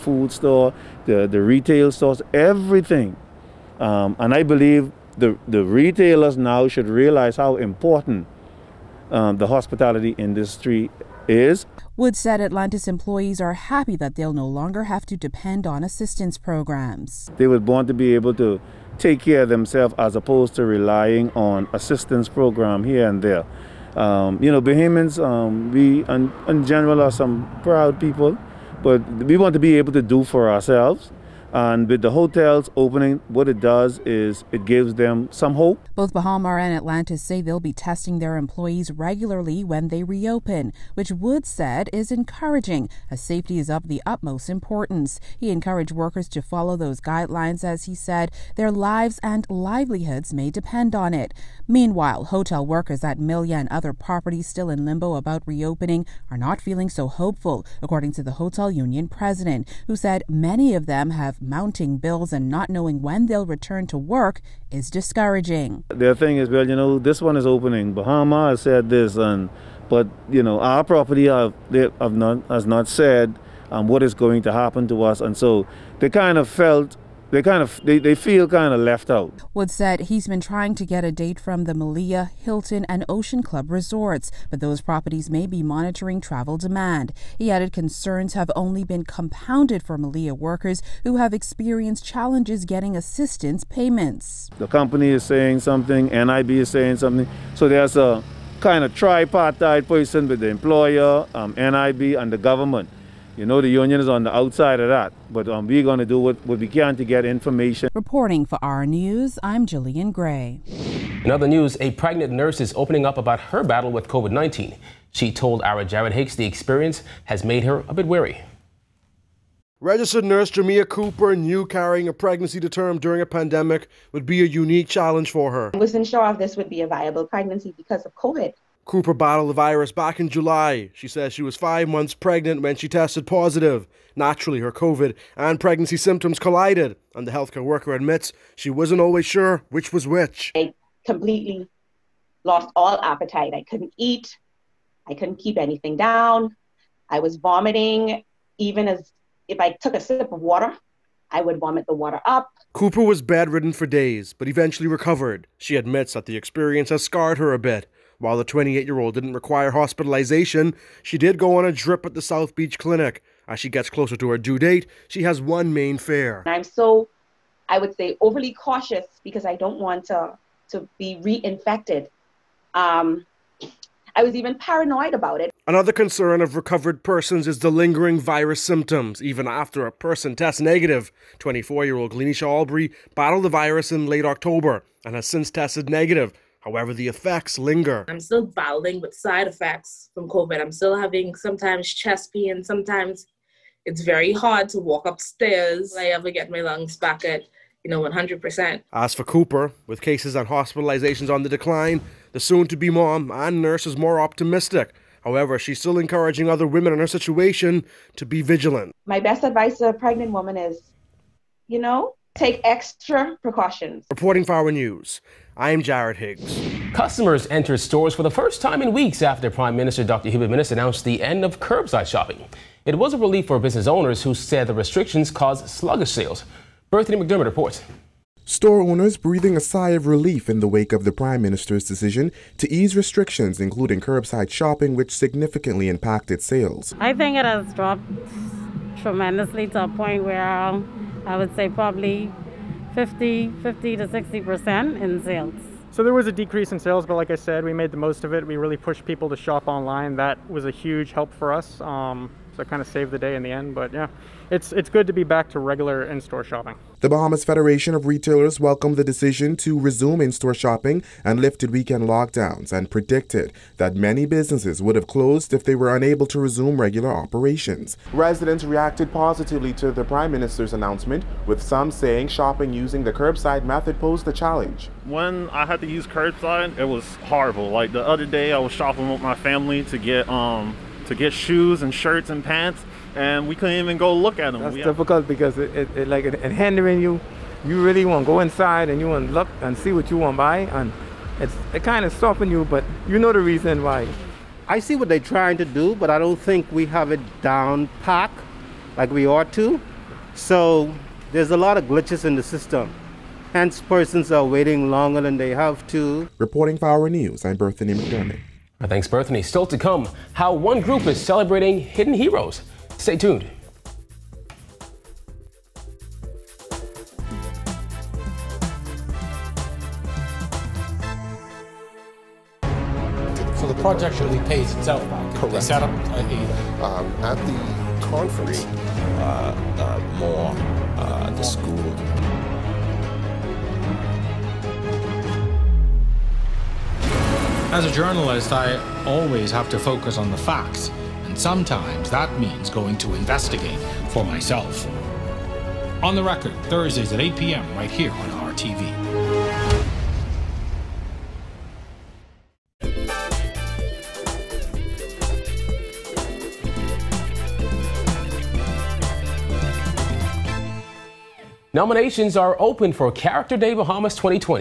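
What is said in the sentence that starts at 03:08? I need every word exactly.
I'm still battling with side effects from COVID.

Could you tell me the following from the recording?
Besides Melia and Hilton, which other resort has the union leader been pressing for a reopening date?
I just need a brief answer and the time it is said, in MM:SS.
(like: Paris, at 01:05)
Ocean Club, at 01:23.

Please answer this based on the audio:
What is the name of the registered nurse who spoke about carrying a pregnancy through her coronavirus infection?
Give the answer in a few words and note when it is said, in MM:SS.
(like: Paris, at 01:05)
Jamia Cooper, at 02:00.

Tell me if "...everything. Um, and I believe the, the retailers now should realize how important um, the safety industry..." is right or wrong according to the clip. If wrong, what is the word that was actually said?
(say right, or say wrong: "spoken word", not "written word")
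wrong: "hospitality", not "safety".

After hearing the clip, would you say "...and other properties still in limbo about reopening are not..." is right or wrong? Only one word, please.
right.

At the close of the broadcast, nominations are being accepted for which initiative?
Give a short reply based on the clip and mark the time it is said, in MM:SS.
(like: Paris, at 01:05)
Character Day Bahamas, at 06:03.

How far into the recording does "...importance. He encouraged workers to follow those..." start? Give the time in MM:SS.
00:44.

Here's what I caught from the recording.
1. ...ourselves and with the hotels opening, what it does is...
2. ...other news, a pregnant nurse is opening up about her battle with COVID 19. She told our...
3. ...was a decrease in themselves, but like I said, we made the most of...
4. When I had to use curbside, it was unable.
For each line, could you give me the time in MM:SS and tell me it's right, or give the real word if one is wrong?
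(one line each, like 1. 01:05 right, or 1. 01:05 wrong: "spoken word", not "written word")
1. 00:30 right
2. 01:51 right
3. 04:06 wrong: "sales", not "themselves"
4. 04:35 wrong: "horrible", not "unable".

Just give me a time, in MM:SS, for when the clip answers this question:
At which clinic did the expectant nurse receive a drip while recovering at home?
02:42.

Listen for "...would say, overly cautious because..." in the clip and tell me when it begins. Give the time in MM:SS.
02:47.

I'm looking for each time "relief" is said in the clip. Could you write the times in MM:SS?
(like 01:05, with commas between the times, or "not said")
03:43, 03:50.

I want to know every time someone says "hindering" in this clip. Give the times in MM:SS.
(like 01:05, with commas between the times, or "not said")
04:46.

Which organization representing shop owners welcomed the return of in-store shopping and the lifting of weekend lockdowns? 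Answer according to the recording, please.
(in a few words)
Bahamas Federation of Retailers.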